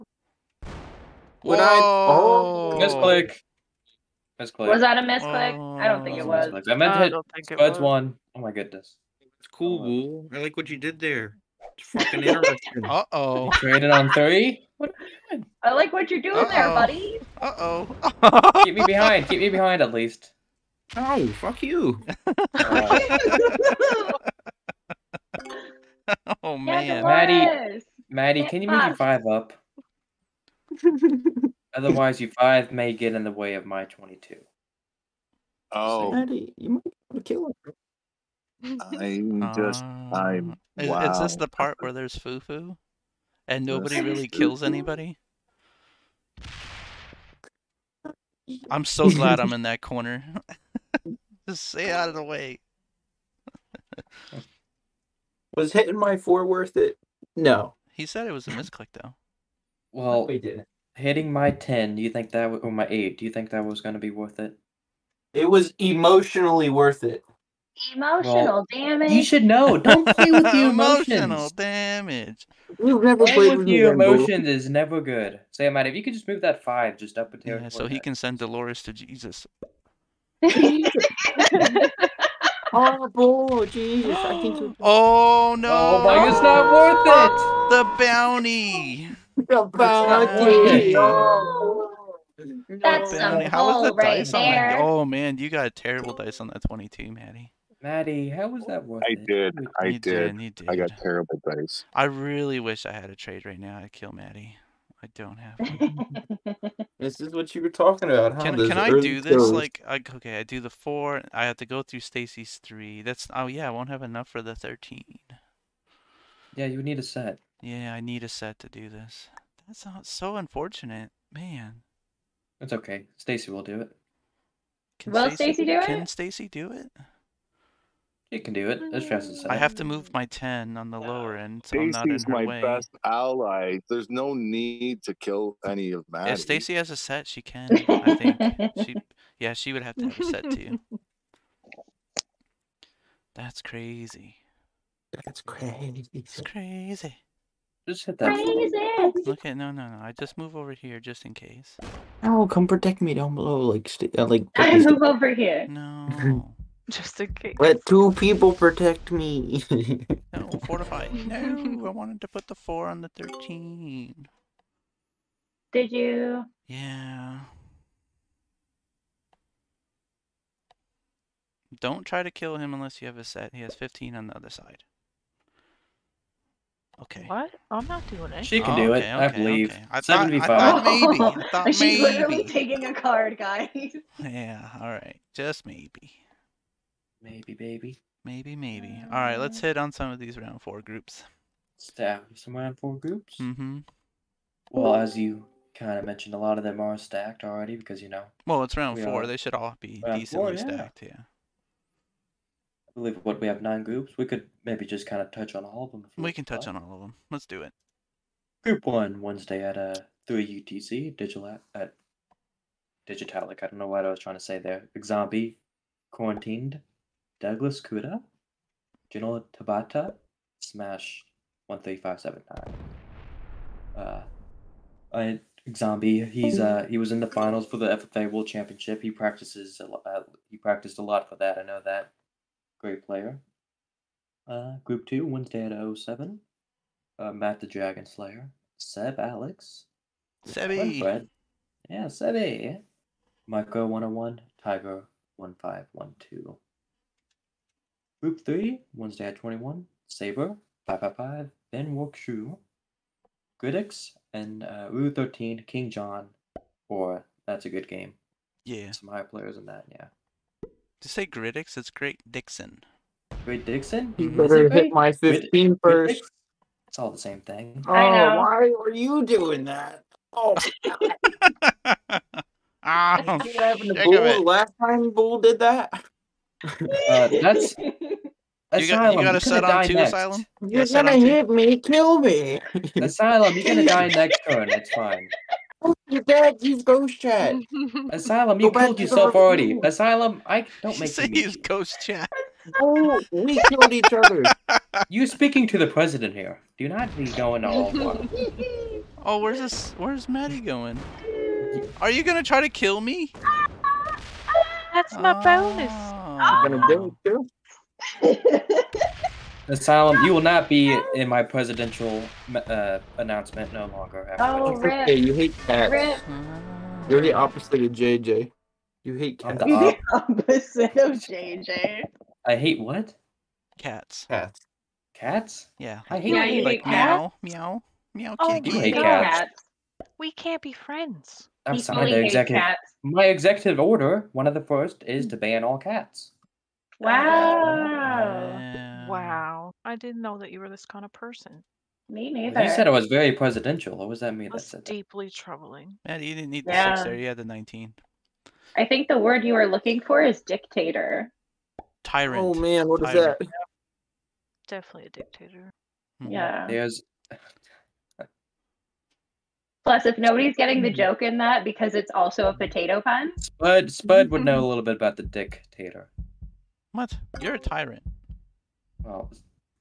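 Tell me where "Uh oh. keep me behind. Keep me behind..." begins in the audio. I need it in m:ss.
0:17.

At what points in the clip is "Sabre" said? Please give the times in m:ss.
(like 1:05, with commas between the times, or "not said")
4:10.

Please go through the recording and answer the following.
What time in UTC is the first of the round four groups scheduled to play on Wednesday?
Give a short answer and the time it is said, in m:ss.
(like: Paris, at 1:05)
3 UTC, at 3:30.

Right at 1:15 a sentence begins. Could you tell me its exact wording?
Say, Matt, if you could just move that five just up a tier.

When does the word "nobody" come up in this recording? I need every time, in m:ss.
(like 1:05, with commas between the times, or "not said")
0:43, 6:00.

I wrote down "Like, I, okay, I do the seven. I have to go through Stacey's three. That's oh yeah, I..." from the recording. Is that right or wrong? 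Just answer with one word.
wrong.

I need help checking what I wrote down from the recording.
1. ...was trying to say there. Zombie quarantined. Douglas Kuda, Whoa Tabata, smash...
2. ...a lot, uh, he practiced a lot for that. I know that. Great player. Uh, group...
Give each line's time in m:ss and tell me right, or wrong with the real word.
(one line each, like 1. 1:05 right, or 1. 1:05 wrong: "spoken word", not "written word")
1. 3:34 wrong: "General", not "Whoa"
2. 3:49 right.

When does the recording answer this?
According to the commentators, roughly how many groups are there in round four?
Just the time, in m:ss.
3:23.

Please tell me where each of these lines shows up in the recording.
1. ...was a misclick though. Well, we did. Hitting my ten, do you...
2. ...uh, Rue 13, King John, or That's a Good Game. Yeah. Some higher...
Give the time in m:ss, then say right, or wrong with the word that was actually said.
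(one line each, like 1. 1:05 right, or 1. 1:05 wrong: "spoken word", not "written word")
1. 0:58 right
2. 4:14 right.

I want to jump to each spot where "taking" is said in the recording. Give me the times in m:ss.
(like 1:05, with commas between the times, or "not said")
3:02.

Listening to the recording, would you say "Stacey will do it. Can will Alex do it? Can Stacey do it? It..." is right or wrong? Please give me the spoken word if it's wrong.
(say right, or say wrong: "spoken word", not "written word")
wrong: "Stacey", not "Alex".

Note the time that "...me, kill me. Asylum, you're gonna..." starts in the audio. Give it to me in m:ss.
4:41.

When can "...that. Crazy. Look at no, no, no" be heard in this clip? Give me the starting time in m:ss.
2:28.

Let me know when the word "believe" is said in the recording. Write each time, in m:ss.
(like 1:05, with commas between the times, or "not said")
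2:59, 3:22.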